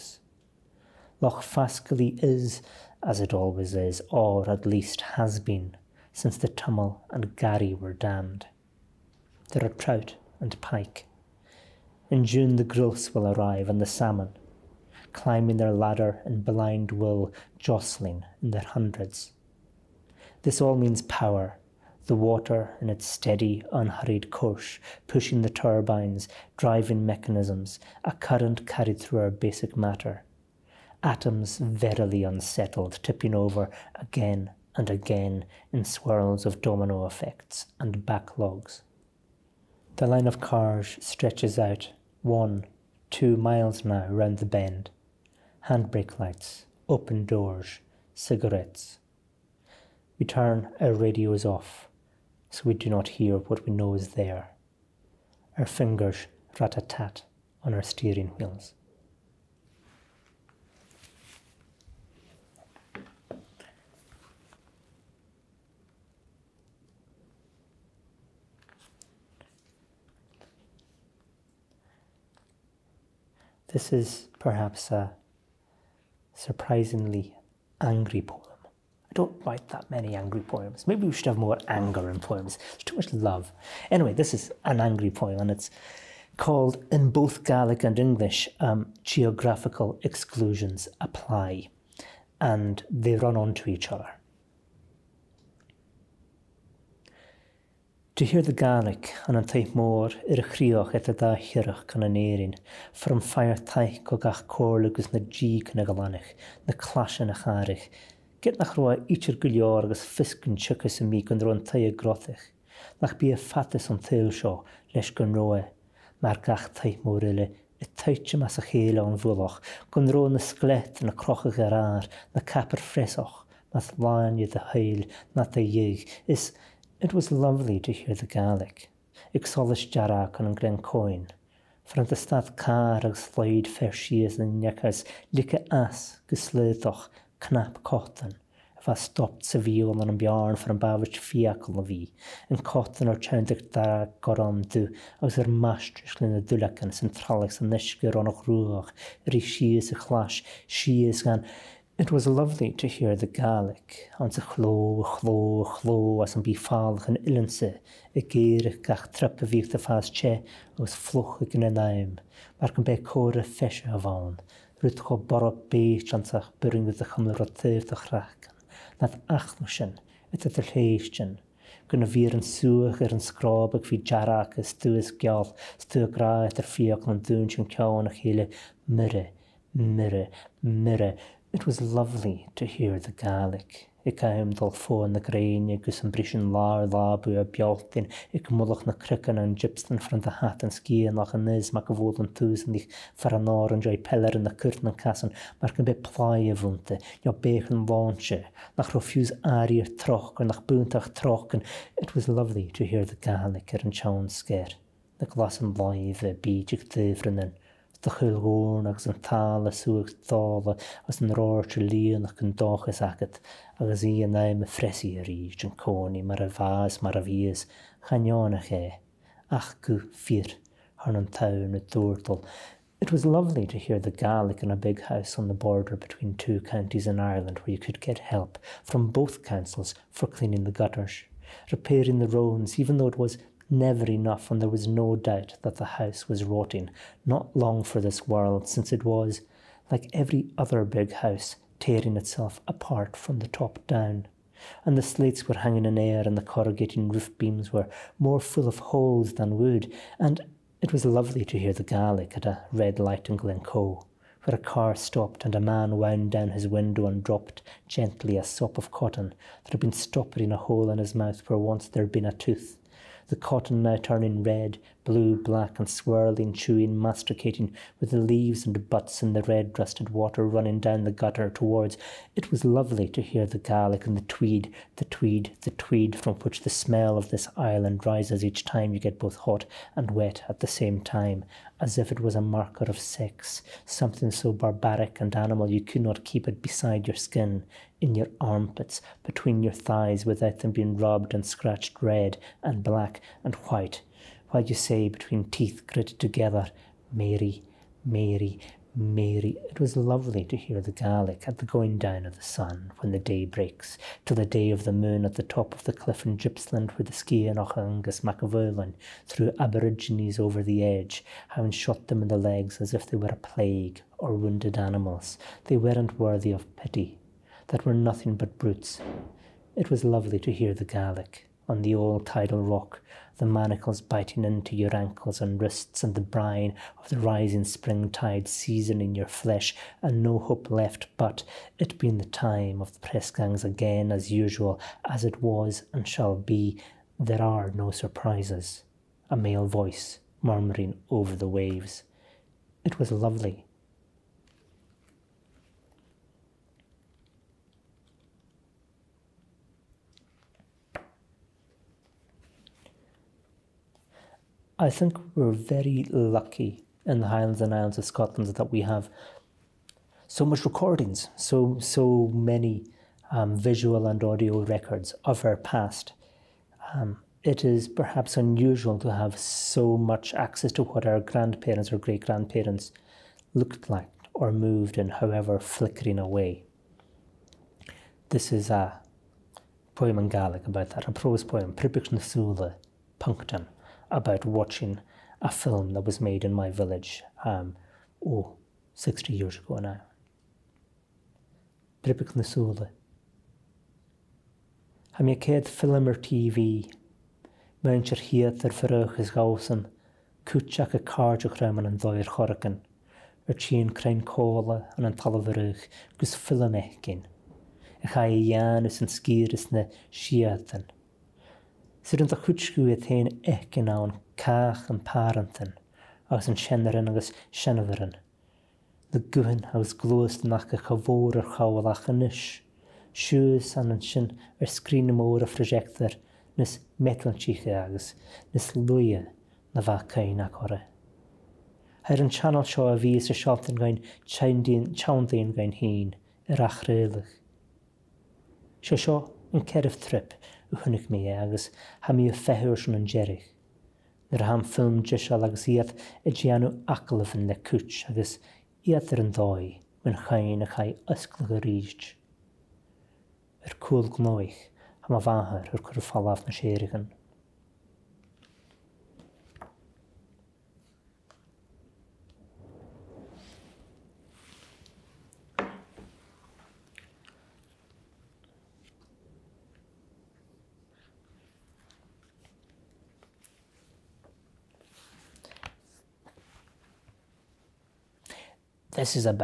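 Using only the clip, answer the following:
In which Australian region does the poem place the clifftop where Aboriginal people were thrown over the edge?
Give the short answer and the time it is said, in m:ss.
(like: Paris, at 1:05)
Gippsland, at 5:06.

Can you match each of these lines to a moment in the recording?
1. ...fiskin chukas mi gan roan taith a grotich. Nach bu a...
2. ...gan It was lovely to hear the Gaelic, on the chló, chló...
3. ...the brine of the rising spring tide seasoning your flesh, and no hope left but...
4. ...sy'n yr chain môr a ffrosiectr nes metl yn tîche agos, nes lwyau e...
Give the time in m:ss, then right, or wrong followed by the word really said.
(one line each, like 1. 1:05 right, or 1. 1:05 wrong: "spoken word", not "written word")
1. 1:49 right
2. 2:31 right
3. 5:26 right
4. 7:04 wrong: "sgrin", not "chain".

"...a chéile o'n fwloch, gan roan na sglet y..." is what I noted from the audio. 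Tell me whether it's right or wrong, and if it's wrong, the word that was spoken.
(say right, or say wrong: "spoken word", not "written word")
right.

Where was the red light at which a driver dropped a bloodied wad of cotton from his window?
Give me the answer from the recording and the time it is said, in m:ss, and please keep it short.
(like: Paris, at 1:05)
Glencoe, at 4:13.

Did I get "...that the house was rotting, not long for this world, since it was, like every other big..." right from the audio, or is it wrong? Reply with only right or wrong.
right.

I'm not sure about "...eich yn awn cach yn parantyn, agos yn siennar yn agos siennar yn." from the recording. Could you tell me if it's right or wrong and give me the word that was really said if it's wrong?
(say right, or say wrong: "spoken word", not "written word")
right.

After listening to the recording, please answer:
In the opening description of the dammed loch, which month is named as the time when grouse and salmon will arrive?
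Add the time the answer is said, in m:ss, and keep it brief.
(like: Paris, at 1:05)
June, at 0:12.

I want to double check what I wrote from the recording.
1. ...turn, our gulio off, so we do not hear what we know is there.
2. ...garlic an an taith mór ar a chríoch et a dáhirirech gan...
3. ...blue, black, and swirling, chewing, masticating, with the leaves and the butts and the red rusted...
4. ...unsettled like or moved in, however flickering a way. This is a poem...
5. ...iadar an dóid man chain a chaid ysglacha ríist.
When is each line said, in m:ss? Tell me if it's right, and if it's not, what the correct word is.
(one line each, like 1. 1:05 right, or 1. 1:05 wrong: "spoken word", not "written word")
1. 0:50 wrong: "radio", not "gulio"
2. 1:38 right
3. 4:25 right
4. 6:13 wrong: "looked", not "unsettled"
5. 7:28 right.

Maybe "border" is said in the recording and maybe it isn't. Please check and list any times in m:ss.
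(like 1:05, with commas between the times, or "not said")
3:45.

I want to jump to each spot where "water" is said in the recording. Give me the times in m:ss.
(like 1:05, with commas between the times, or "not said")
0:22, 4:30.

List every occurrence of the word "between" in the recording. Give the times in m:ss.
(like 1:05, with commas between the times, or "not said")
3:45, 4:49, 4:55.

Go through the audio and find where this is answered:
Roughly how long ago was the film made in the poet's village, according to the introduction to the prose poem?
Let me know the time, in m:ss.
6:28.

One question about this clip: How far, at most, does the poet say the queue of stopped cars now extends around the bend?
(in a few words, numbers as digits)
2 miles.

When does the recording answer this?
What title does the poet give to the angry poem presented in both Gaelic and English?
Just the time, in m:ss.
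1:29.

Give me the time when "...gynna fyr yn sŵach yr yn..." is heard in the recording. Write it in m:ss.
2:51.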